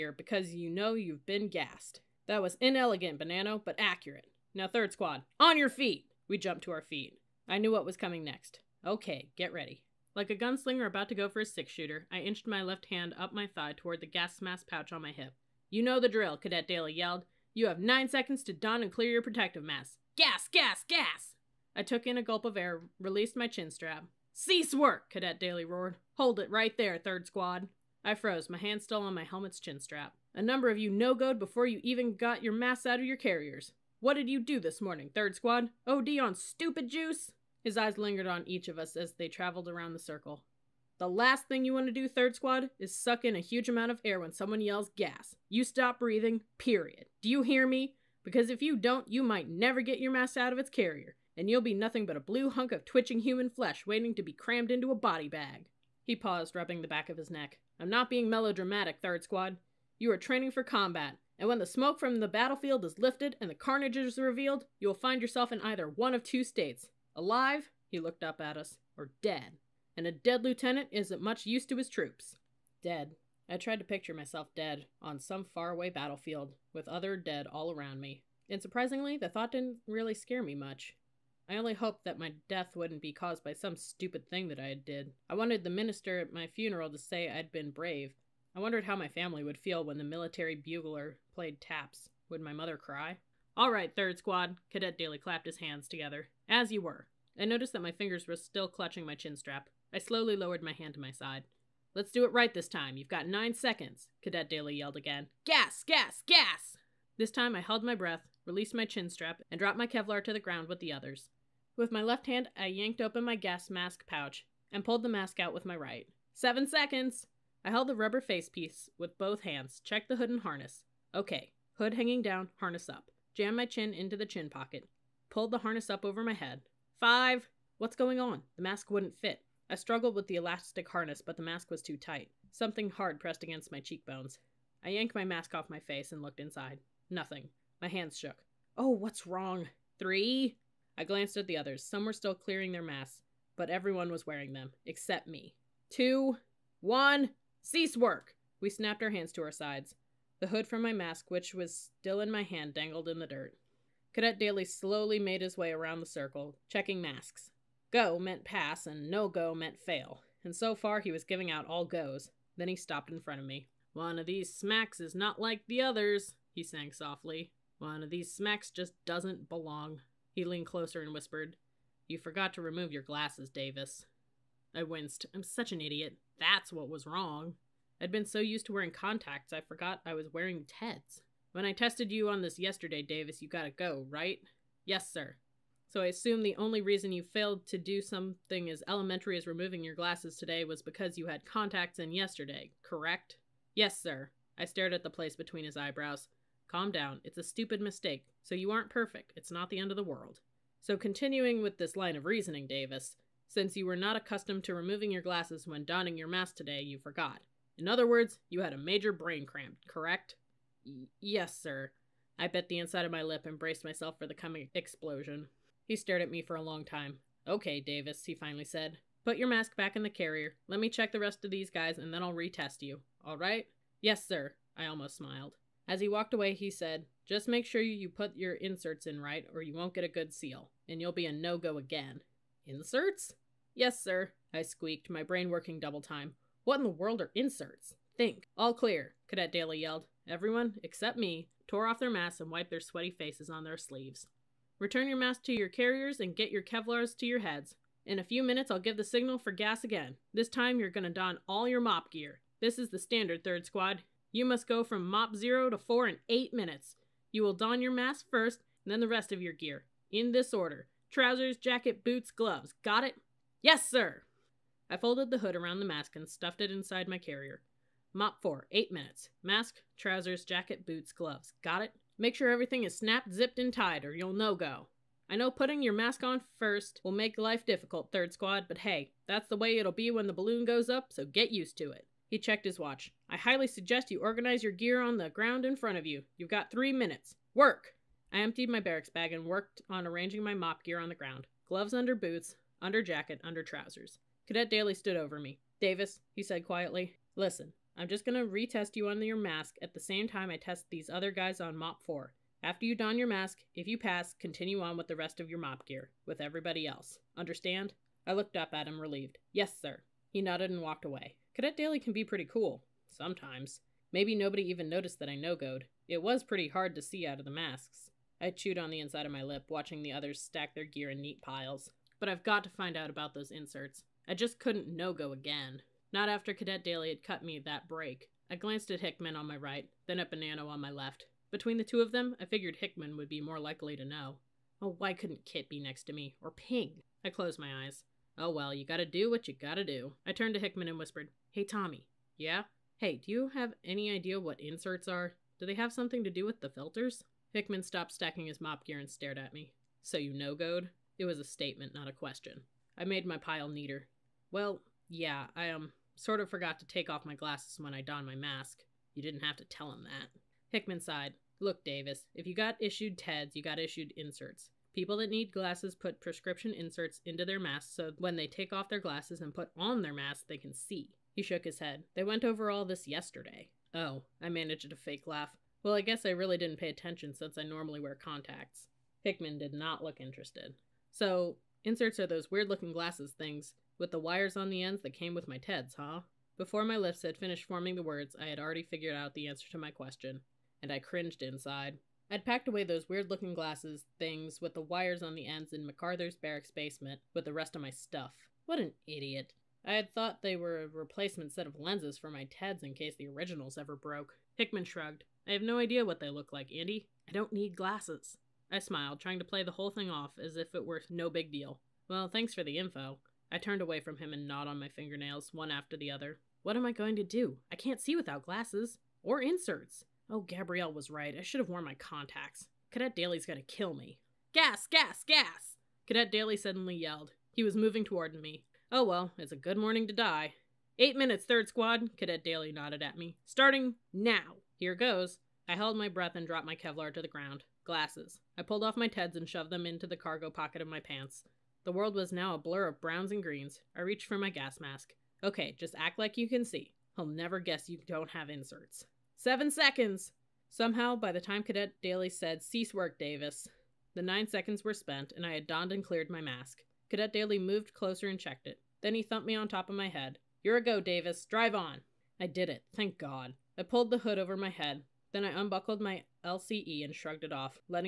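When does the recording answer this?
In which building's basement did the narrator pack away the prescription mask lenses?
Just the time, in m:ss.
6:35.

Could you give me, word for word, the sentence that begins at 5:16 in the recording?
It was pretty hard to see out of the masks.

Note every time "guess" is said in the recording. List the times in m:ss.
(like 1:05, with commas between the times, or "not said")
6:16, 7:27.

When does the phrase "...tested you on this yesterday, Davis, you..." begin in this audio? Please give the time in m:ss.
3:01.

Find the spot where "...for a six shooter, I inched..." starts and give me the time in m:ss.
0:11.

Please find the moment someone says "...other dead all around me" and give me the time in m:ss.
1:16.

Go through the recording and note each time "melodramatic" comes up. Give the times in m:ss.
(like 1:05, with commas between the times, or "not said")
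0:58.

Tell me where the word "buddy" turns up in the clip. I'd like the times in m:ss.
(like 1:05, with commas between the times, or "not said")
not said.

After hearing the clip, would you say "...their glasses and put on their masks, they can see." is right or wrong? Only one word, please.
right.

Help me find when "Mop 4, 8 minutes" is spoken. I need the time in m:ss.
4:28.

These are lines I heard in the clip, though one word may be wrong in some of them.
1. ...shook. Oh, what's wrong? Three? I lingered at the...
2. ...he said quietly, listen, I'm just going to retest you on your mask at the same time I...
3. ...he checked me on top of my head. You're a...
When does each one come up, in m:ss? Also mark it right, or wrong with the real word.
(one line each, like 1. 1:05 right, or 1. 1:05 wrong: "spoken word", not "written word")
1. 2:18 wrong: "glanced", not "lingered"
2. 4:56 right
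3. 7:39 wrong: "thumped", not "checked".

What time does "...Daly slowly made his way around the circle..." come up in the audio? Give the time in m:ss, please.
2:34.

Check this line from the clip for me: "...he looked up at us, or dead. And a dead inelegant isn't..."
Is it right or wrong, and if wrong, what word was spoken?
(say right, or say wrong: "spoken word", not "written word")
wrong: "lieutenant", not "inelegant".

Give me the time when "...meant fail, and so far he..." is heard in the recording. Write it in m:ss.
2:39.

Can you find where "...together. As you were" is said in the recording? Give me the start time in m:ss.
1:35.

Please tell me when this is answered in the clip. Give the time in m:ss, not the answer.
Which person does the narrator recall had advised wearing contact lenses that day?
7:00.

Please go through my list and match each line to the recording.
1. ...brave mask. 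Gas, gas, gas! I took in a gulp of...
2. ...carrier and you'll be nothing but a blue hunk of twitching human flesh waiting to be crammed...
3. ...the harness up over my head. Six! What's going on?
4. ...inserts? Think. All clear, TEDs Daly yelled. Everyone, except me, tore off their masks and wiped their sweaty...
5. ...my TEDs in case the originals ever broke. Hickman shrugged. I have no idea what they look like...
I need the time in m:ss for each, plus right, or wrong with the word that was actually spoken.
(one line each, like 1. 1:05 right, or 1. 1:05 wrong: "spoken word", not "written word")
1. 0:19 wrong: "protective", not "brave"
2. 0:50 right
3. 2:05 wrong: "Five", not "Six"
4. 3:57 wrong: "Cadet", not "TEDs"
5. 6:42 right.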